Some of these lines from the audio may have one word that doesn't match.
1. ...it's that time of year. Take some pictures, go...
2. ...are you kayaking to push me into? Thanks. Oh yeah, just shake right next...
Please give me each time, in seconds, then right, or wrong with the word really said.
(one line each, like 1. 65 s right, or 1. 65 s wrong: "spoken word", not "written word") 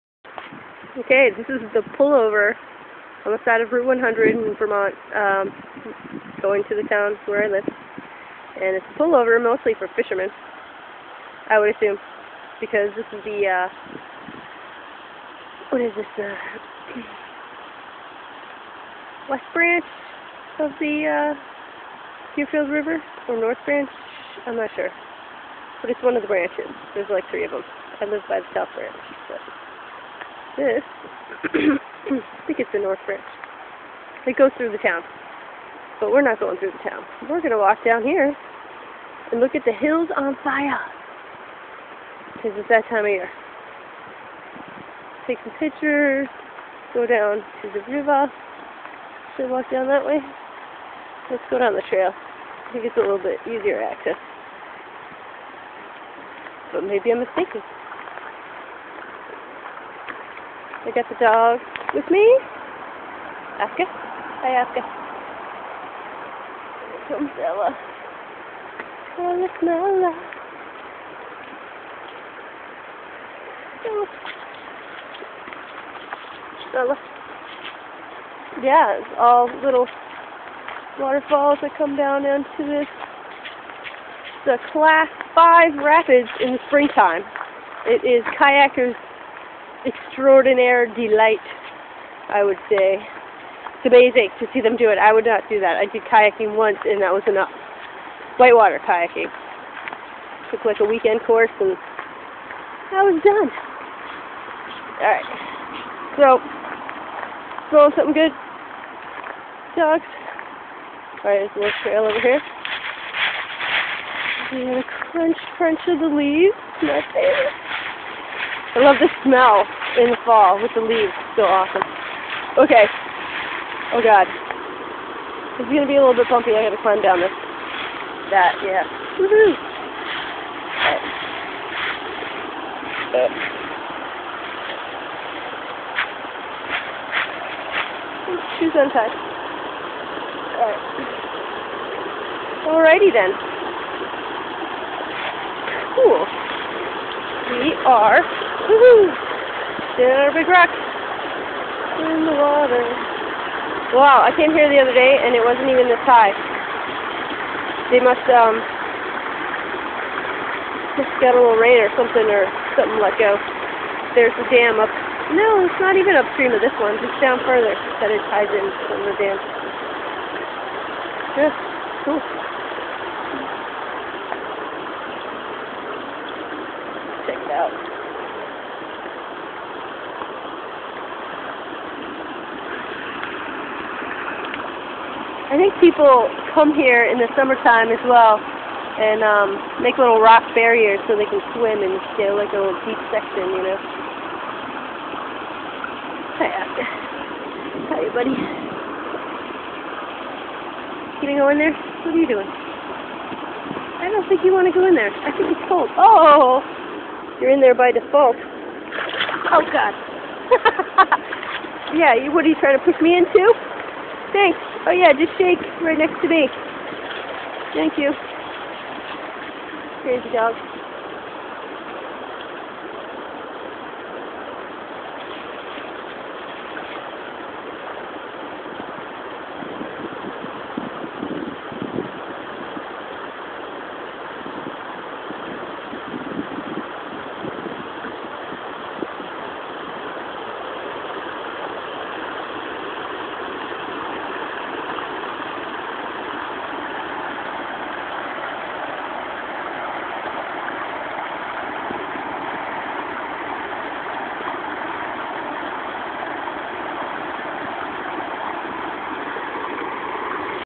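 1. 42 s right
2. 212 s wrong: "trying", not "kayaking".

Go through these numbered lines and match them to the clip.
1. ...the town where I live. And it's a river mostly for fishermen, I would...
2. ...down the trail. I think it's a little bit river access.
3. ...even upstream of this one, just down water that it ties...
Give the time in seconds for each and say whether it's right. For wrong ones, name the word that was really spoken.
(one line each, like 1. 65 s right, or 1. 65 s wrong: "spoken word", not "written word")
1. 6 s wrong: "pullover", not "river"
2. 51 s wrong: "easier", not "river"
3. 165 s wrong: "further", not "water".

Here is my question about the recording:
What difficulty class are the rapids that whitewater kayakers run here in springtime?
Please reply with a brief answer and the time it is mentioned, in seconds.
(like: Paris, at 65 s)
Class five, at 84 s.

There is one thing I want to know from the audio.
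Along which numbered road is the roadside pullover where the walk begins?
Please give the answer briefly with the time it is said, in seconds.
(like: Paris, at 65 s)
Route 100, at 3 s.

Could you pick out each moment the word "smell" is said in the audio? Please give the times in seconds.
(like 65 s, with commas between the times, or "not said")
119 s.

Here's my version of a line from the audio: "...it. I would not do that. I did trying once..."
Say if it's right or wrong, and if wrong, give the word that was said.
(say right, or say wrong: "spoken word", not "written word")
wrong: "kayaking", not "trying".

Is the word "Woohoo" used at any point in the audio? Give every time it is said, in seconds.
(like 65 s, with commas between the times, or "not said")
129 s, 148 s.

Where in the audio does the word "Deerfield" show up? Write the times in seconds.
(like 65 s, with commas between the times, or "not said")
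22 s.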